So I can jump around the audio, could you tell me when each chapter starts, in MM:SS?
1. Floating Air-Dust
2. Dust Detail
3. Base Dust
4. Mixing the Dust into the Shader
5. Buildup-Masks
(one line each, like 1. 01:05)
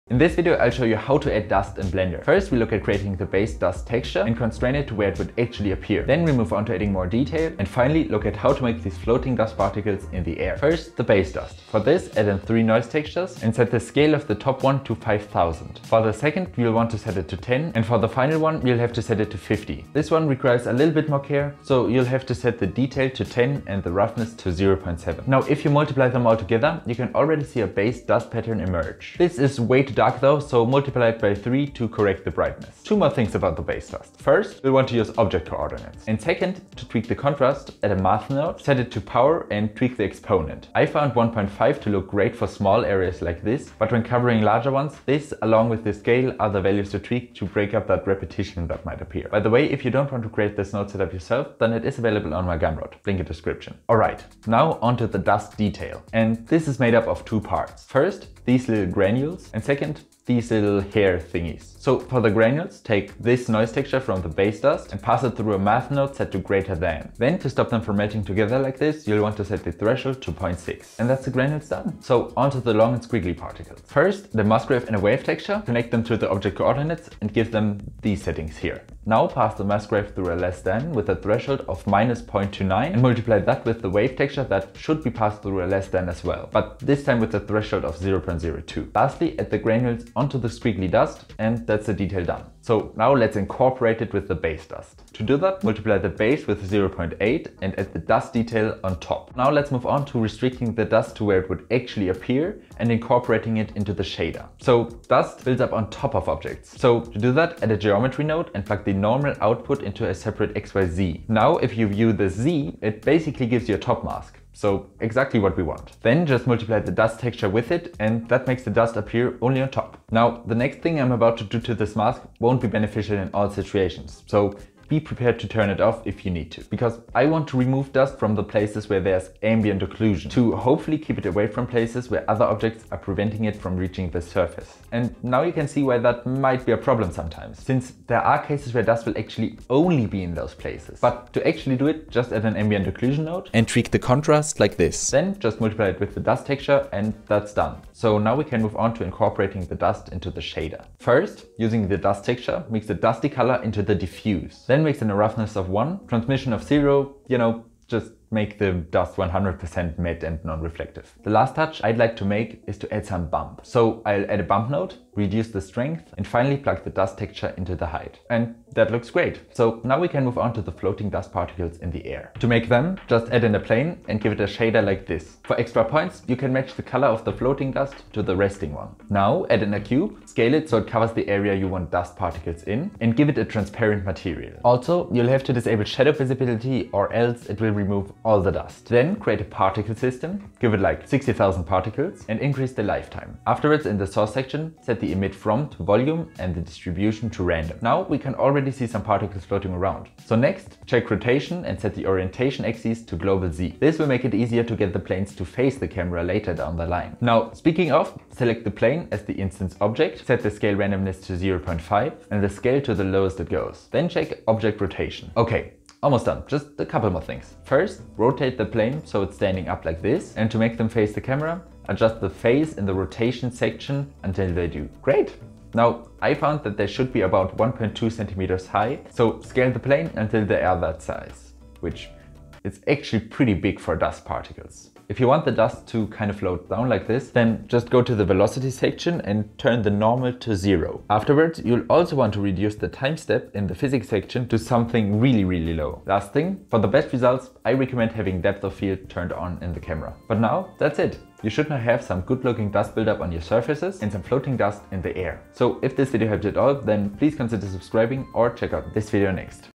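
1. 02:50
2. 00:55
3. 00:11
4. 02:29
5. 01:42.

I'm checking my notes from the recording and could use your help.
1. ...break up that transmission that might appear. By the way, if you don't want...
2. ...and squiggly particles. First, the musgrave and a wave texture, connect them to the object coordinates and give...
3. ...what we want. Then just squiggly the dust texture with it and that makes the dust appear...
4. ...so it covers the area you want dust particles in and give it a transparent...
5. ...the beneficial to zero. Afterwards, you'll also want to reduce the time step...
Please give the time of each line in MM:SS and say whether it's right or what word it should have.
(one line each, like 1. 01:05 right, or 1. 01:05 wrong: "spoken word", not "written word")
1. 00:47 wrong: "repetition", not "transmission"
2. 01:12 right
3. 01:55 wrong: "multiply", not "squiggly"
4. 03:00 right
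5. 03:59 wrong: "normal", not "beneficial".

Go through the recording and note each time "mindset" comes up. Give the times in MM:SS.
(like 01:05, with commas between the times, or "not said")
not said.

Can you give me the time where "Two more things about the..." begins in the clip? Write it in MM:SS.
00:32.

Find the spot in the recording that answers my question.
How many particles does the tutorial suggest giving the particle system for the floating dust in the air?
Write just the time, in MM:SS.
03:11.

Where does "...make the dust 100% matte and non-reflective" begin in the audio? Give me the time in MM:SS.
02:38.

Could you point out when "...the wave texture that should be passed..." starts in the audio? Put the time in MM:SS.
01:23.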